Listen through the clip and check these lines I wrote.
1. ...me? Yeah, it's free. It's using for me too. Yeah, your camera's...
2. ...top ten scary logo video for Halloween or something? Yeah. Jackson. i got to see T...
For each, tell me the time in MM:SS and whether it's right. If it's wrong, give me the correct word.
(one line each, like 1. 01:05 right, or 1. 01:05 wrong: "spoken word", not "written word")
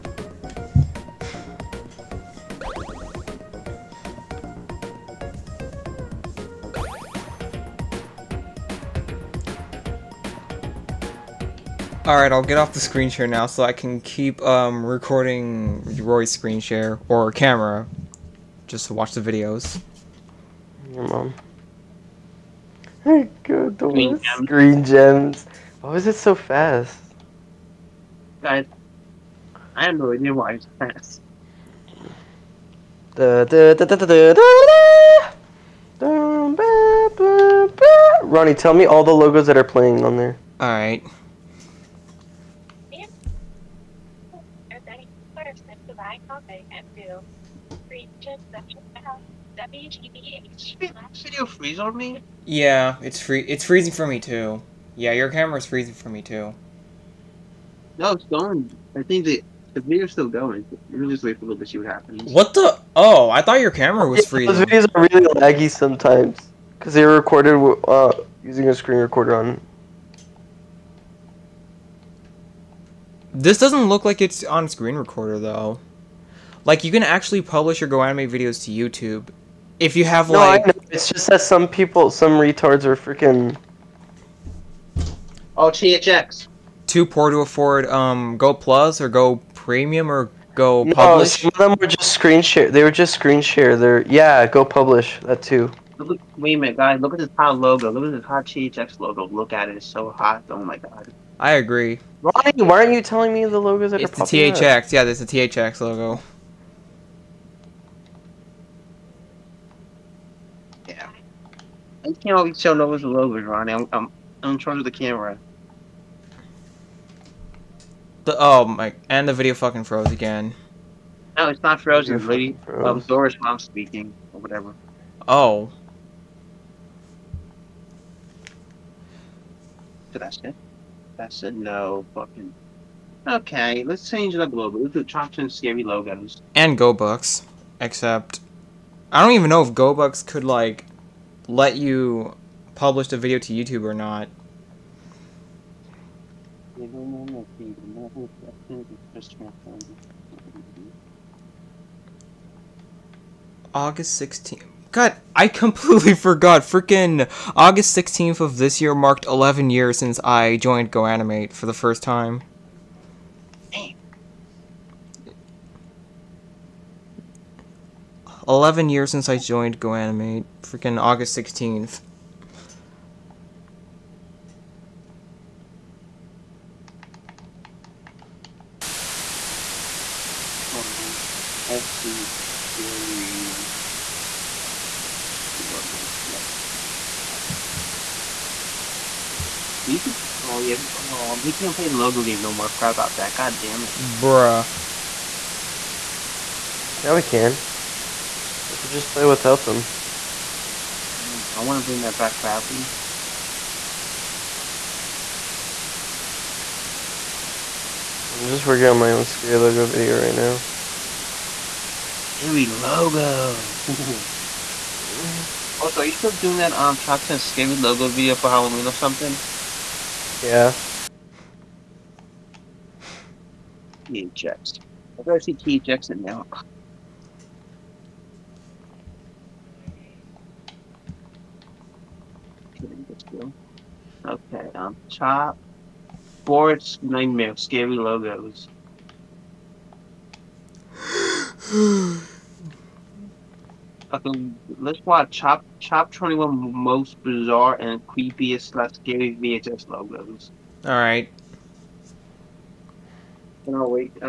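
1. 00:51 wrong: "freezing", not "using"
2. 03:36 right.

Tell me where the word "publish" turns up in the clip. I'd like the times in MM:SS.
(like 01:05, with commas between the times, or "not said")
01:17, 01:34, 02:22.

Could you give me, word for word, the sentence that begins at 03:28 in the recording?
I'm just working on my own scary logo video right now.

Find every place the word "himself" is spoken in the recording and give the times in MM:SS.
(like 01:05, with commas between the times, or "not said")
not said.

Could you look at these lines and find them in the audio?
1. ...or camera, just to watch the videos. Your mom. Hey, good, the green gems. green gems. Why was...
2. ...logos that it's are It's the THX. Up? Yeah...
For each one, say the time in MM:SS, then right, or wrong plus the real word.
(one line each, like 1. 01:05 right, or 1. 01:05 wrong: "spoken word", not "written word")
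1. 00:17 right
2. 01:43 right.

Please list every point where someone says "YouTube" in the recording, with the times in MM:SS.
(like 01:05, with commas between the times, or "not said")
01:18, 02:23.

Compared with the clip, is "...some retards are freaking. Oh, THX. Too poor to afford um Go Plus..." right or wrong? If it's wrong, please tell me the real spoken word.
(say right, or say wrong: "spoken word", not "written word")
right.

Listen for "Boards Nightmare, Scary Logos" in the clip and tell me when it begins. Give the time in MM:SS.
03:56.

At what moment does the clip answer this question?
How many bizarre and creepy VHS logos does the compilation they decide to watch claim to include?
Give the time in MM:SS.
04:06.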